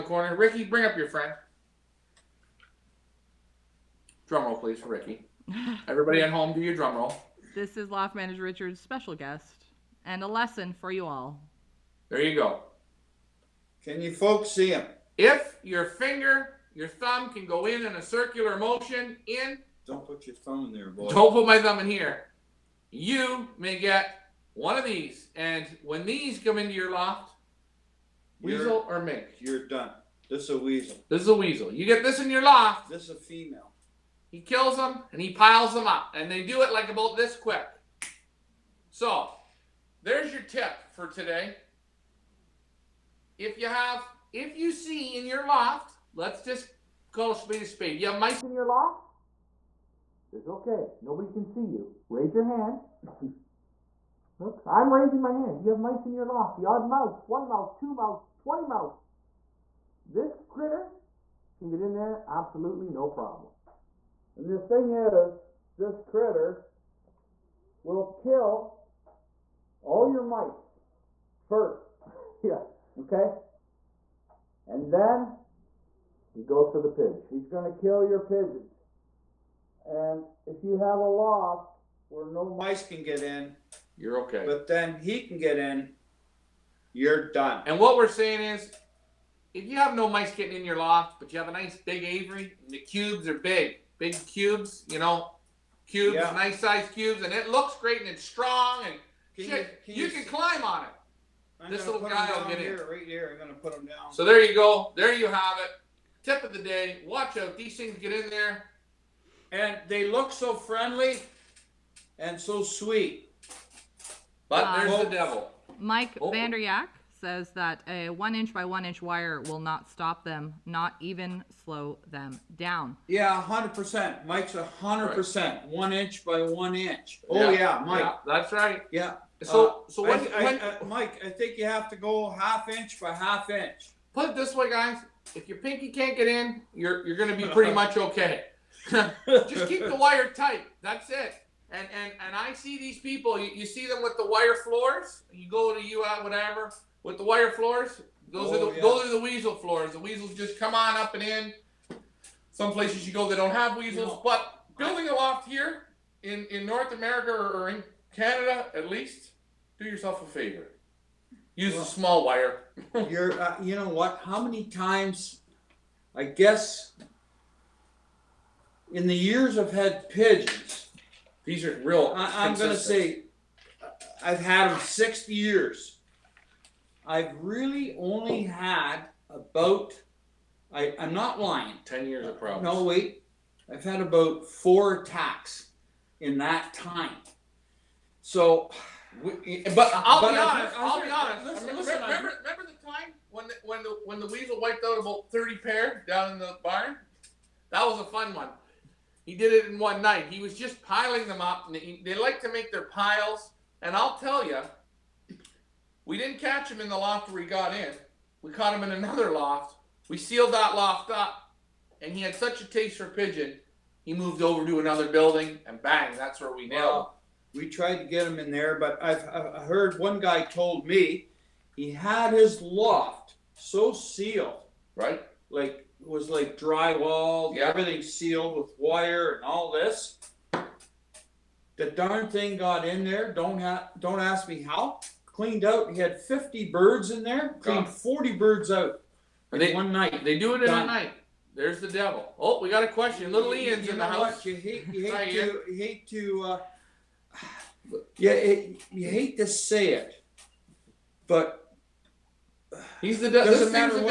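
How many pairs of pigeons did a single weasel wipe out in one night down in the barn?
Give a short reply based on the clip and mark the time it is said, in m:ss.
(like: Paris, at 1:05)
30, at 3:15.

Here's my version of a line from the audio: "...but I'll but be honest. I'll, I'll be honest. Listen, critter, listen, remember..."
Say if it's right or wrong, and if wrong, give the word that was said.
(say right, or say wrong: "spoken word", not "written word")
wrong: "remember", not "critter".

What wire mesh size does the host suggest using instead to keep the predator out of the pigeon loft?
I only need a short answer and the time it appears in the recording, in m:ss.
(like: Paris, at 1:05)
half inch by half inch, at 2:12.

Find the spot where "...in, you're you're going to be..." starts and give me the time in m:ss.
2:16.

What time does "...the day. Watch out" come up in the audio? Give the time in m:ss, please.
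1:46.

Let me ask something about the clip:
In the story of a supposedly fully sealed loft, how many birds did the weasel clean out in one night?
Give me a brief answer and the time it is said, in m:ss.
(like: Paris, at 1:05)
40, at 3:57.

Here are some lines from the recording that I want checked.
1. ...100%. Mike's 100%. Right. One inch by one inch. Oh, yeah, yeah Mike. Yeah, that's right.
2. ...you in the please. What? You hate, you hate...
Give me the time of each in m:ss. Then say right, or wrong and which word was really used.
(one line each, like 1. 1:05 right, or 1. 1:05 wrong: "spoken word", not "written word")
1. 2:03 right
2. 4:03 wrong: "house", not "please".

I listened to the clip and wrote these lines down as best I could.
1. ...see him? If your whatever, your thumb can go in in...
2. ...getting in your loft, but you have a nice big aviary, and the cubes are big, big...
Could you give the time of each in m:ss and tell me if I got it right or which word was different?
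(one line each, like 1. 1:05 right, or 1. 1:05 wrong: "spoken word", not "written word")
1. 0:14 wrong: "finger", not "whatever"
2. 1:30 right.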